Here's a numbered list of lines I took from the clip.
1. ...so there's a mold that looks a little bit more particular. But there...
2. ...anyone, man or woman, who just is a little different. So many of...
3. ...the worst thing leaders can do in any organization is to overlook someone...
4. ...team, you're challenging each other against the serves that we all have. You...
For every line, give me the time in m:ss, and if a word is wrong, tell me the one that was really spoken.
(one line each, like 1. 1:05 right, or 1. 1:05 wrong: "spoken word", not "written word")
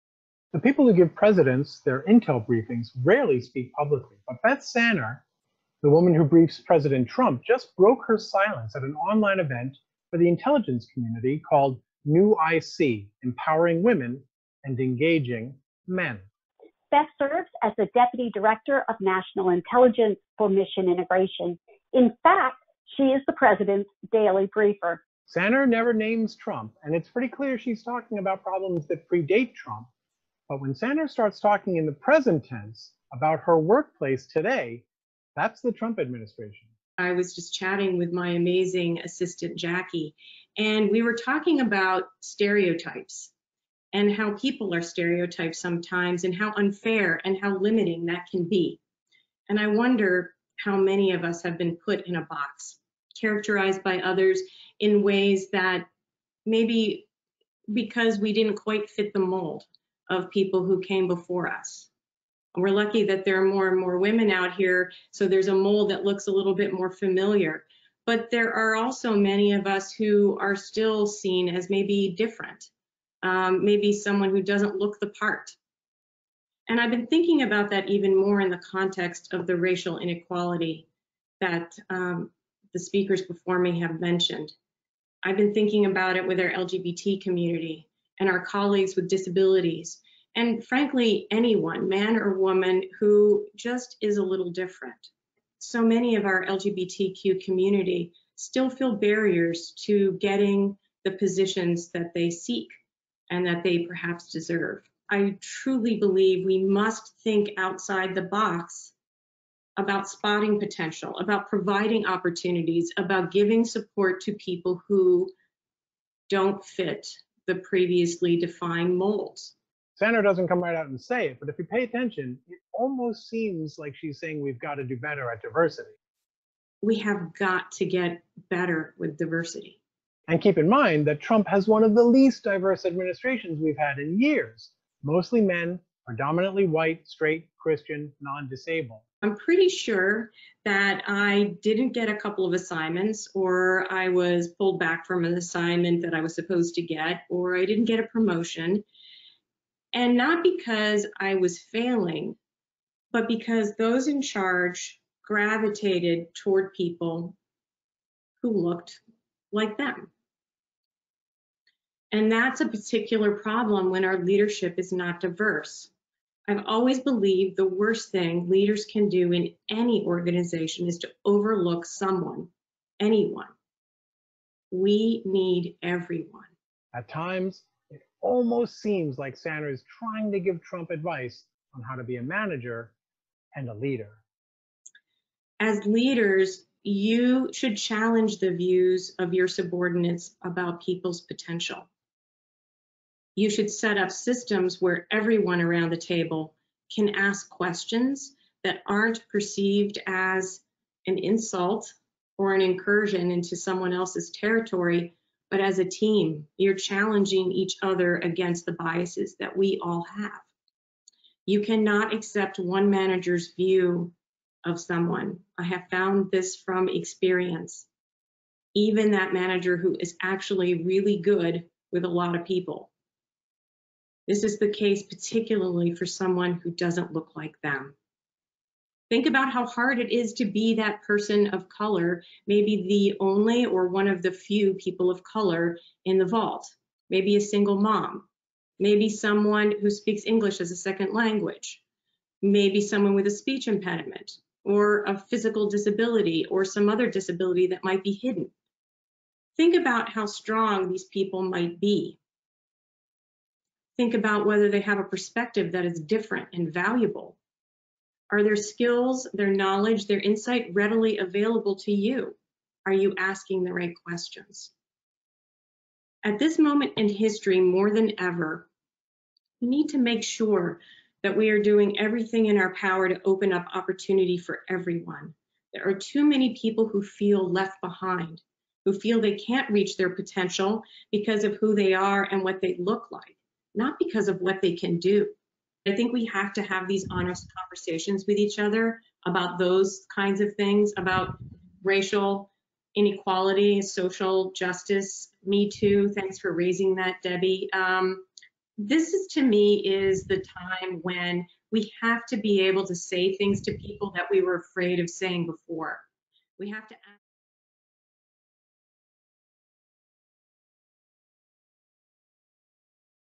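1. 1:05 wrong: "familiar", not "particular"
2. 1:31 right
3. 2:47 right
4. 3:25 wrong: "biases", not "serves".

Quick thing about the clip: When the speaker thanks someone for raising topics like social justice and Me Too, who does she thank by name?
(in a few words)
Debbie.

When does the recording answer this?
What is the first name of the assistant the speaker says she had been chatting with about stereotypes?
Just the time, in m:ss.
0:39.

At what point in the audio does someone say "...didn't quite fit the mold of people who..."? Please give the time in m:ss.
0:58.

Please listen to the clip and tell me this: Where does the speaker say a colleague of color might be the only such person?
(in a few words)
the vault.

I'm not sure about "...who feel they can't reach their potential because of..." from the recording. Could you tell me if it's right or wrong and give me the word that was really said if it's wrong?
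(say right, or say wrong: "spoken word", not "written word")
right.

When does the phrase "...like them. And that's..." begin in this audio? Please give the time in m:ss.
2:39.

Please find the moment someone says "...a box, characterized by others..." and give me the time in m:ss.
0:52.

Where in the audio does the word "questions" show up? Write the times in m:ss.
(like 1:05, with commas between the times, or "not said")
3:17, 4:24.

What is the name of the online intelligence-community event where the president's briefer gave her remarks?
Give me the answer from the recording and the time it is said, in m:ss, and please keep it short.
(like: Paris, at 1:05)
New IC Empowering Women and Engaging Men, at 0:12.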